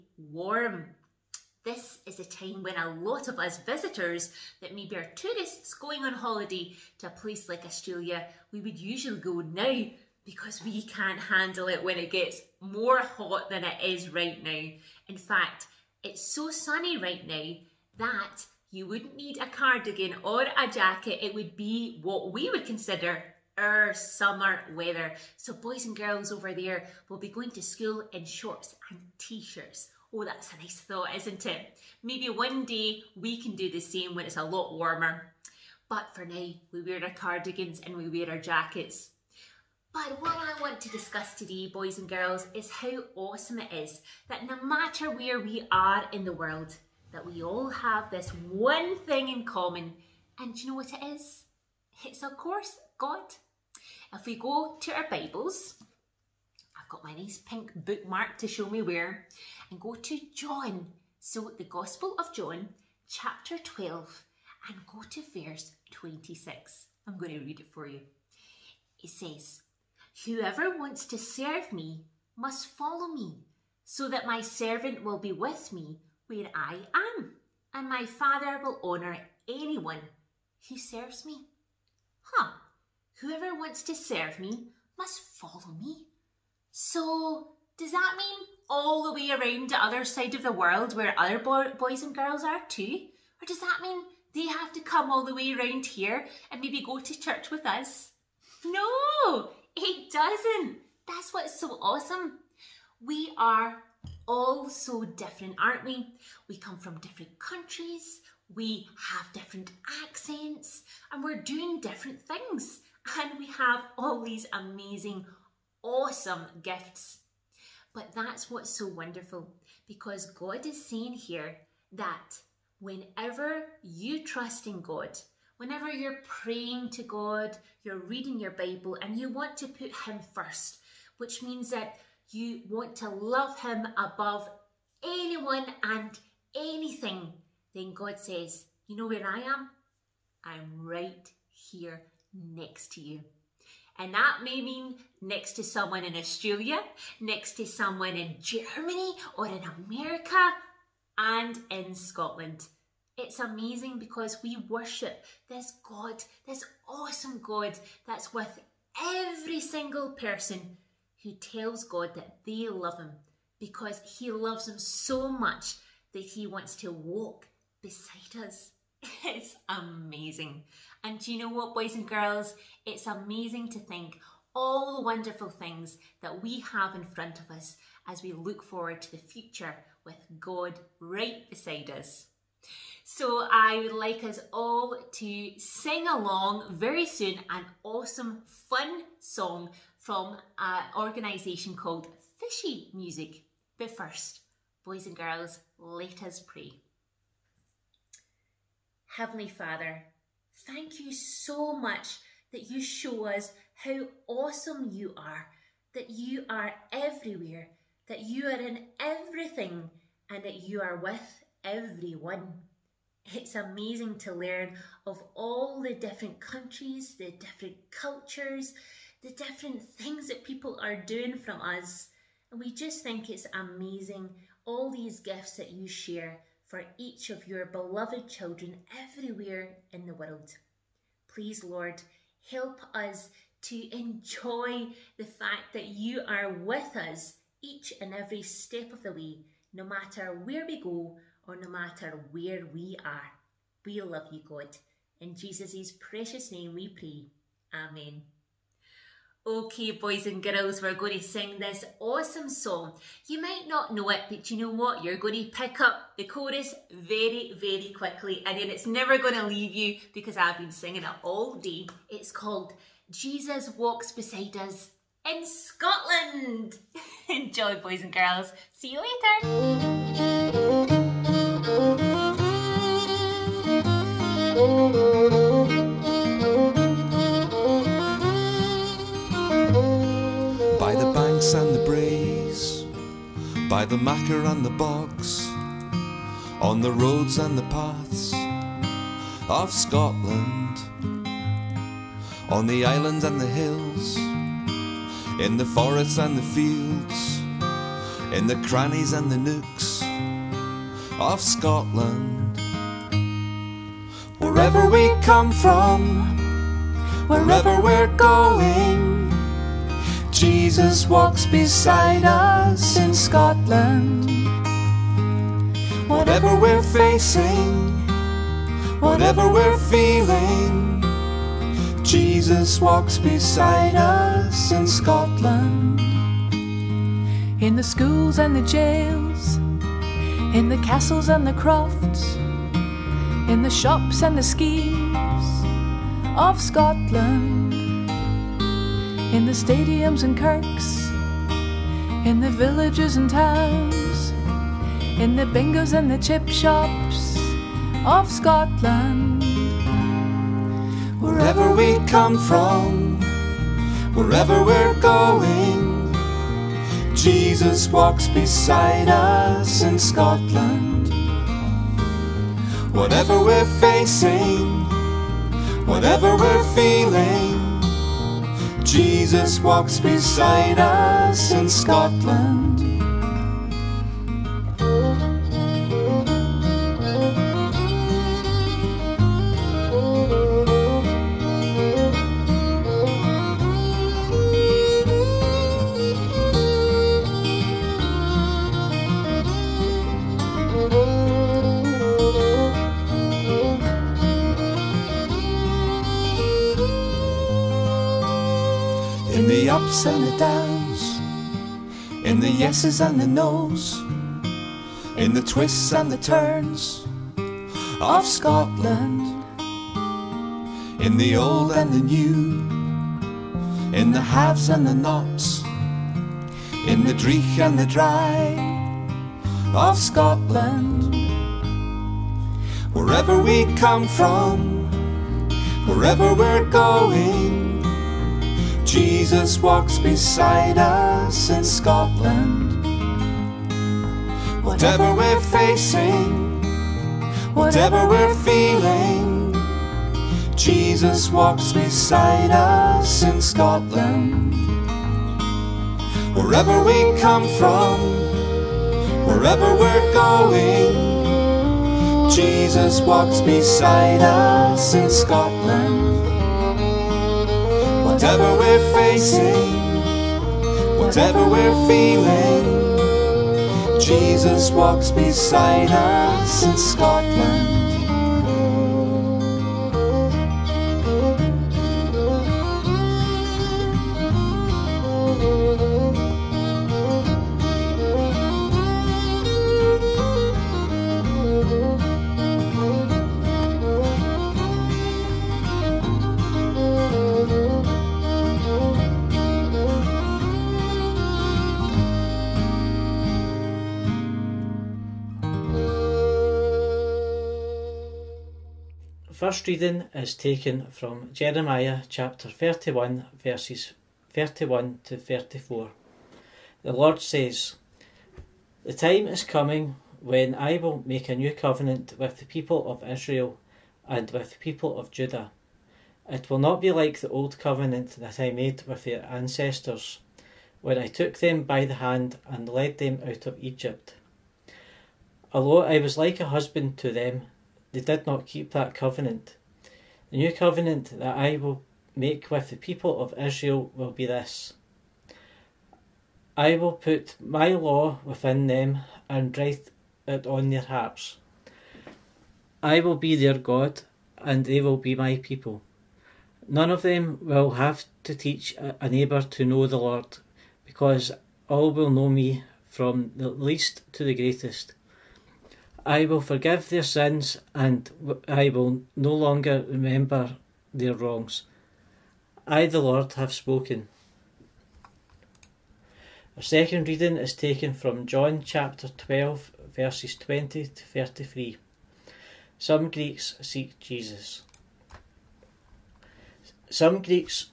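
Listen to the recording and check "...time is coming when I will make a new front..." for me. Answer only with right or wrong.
wrong.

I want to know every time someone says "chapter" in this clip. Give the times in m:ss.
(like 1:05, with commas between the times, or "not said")
1:03, 8:22, 9:28.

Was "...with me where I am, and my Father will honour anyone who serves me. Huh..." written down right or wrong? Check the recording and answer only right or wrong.
right.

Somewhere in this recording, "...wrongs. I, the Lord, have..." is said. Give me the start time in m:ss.
9:21.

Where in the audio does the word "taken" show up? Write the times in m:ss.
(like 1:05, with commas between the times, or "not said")
8:20, 9:27.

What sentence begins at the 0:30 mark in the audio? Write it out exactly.
Oh, that's a nice thought, isn't it?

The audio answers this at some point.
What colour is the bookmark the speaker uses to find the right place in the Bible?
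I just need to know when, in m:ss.
0:57.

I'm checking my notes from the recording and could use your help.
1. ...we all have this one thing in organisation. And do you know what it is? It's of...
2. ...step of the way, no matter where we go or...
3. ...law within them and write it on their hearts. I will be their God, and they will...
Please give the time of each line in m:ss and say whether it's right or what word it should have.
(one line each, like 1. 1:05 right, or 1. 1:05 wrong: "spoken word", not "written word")
1. 0:47 wrong: "common", not "organisation"
2. 3:58 right
3. 8:57 right.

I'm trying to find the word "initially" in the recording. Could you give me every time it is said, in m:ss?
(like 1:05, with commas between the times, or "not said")
not said.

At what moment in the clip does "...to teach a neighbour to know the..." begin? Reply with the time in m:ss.
9:08.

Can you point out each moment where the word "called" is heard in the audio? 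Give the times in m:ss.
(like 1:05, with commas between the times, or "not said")
3:11, 4:22.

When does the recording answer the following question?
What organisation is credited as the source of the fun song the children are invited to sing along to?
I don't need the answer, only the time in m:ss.
3:12.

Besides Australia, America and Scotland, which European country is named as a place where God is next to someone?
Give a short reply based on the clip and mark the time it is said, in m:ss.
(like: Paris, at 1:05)
Germany, at 2:28.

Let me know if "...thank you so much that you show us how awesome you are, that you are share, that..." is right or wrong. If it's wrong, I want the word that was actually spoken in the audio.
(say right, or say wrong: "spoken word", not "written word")
wrong: "everywhere", not "share".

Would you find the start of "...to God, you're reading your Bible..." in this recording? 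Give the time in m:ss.
2:06.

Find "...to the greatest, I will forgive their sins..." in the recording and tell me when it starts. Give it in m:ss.
9:14.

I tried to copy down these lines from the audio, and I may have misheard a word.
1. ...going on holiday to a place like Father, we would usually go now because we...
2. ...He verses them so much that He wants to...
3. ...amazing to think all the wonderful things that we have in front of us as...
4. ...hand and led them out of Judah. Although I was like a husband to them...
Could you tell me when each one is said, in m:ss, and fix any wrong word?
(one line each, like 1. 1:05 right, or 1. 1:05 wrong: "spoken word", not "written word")
1. 0:05 wrong: "Australia", not "Father"
2. 2:44 wrong: "loves", not "verses"
3. 2:53 right
4. 8:42 wrong: "Egypt", not "Judah".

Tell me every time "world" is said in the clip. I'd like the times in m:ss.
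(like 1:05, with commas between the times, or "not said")
0:46, 1:30, 3:50.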